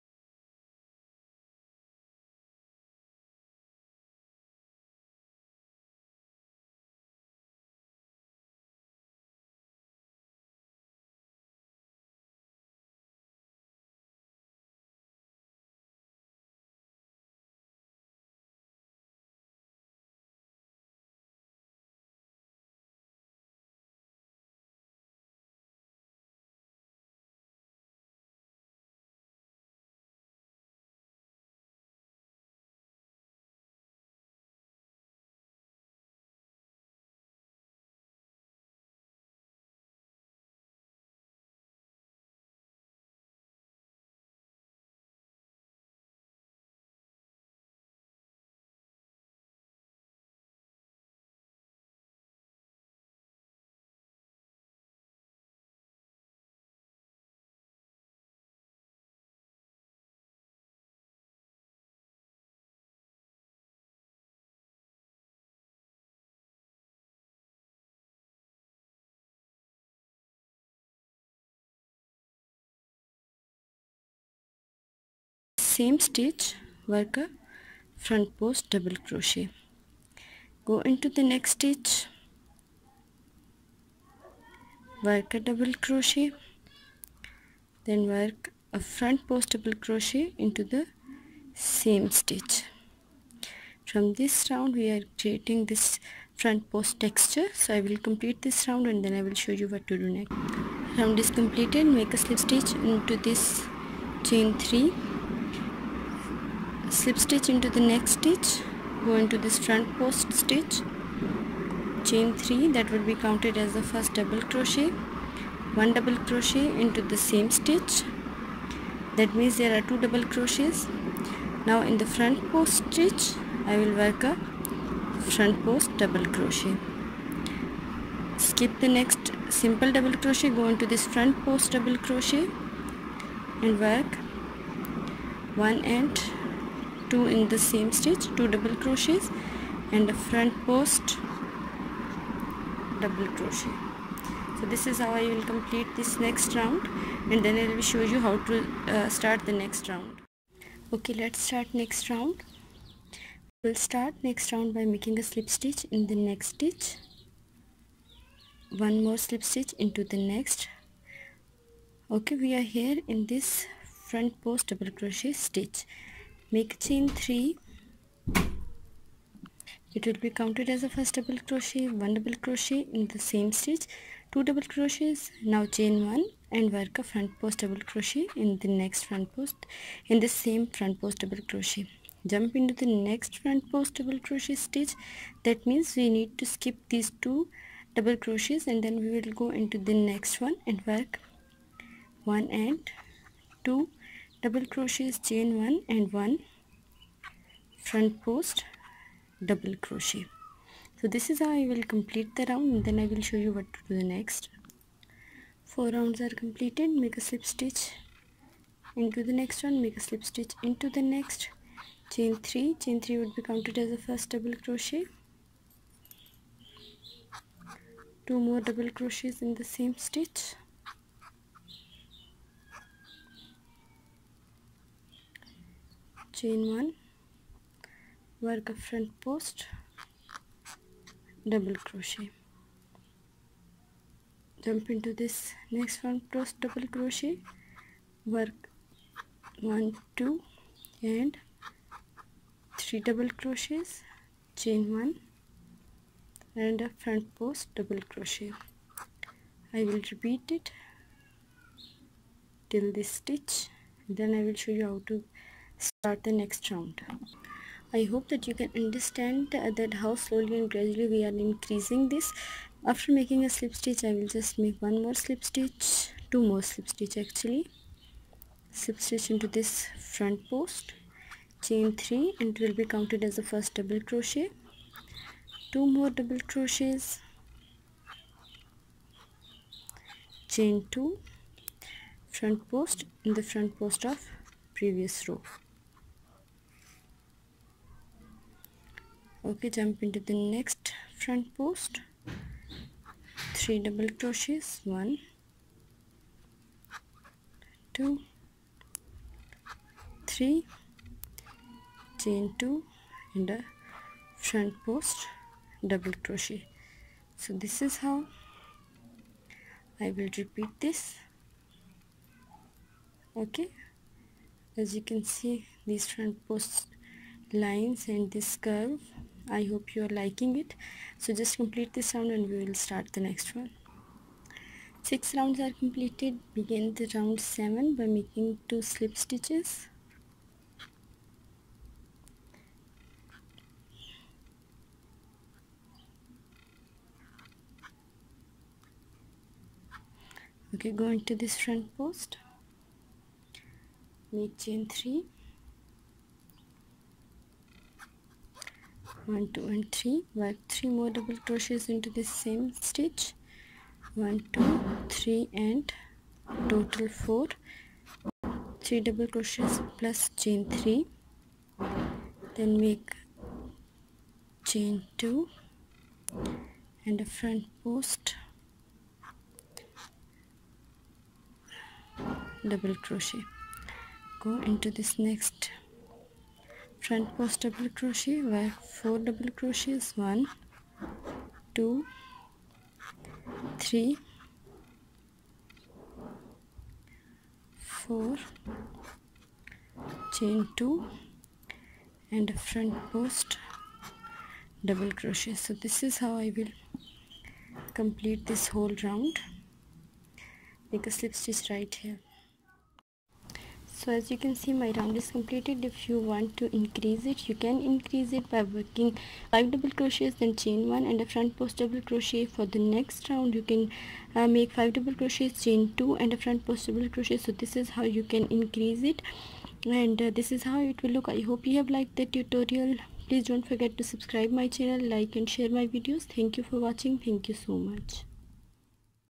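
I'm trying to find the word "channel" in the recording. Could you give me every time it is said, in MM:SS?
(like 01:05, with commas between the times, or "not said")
07:04.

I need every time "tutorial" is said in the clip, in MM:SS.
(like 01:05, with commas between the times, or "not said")
07:02.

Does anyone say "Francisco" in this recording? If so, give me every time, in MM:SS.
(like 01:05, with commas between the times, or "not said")
not said.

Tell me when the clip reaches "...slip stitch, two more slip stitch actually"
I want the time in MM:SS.
04:25.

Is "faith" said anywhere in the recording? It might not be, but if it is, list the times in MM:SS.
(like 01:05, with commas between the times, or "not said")
not said.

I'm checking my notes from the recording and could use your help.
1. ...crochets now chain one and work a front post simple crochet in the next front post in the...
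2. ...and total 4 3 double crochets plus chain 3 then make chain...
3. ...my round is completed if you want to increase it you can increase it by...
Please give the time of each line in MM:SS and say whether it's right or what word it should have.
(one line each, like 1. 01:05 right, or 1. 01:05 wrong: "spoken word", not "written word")
1. 02:54 wrong: "double", not "simple"
2. 05:55 right
3. 06:44 right.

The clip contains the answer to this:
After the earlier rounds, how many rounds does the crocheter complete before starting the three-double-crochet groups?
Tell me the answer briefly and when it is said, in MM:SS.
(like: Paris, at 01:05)
4, at 03:25.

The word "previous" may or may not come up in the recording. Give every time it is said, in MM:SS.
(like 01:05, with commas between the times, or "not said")
04:44.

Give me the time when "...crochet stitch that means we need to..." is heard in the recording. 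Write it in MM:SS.
03:04.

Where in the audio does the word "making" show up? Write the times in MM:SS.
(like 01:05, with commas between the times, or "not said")
02:34, 04:23, 05:28.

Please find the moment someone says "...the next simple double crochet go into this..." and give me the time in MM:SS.
02:08.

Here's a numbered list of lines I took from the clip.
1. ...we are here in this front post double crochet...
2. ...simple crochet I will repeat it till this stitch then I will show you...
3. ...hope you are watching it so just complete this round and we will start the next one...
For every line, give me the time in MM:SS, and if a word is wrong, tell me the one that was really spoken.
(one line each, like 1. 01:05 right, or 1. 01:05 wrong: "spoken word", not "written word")
1. 02:42 right
2. 04:07 wrong: "double", not "simple"
3. 05:19 wrong: "liking", not "watching".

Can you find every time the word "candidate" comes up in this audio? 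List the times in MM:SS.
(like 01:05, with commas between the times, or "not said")
not said.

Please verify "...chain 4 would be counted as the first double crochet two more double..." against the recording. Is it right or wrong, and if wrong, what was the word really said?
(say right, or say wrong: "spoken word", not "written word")
wrong: "3", not "4".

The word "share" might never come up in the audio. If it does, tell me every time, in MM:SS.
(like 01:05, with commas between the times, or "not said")
07:05.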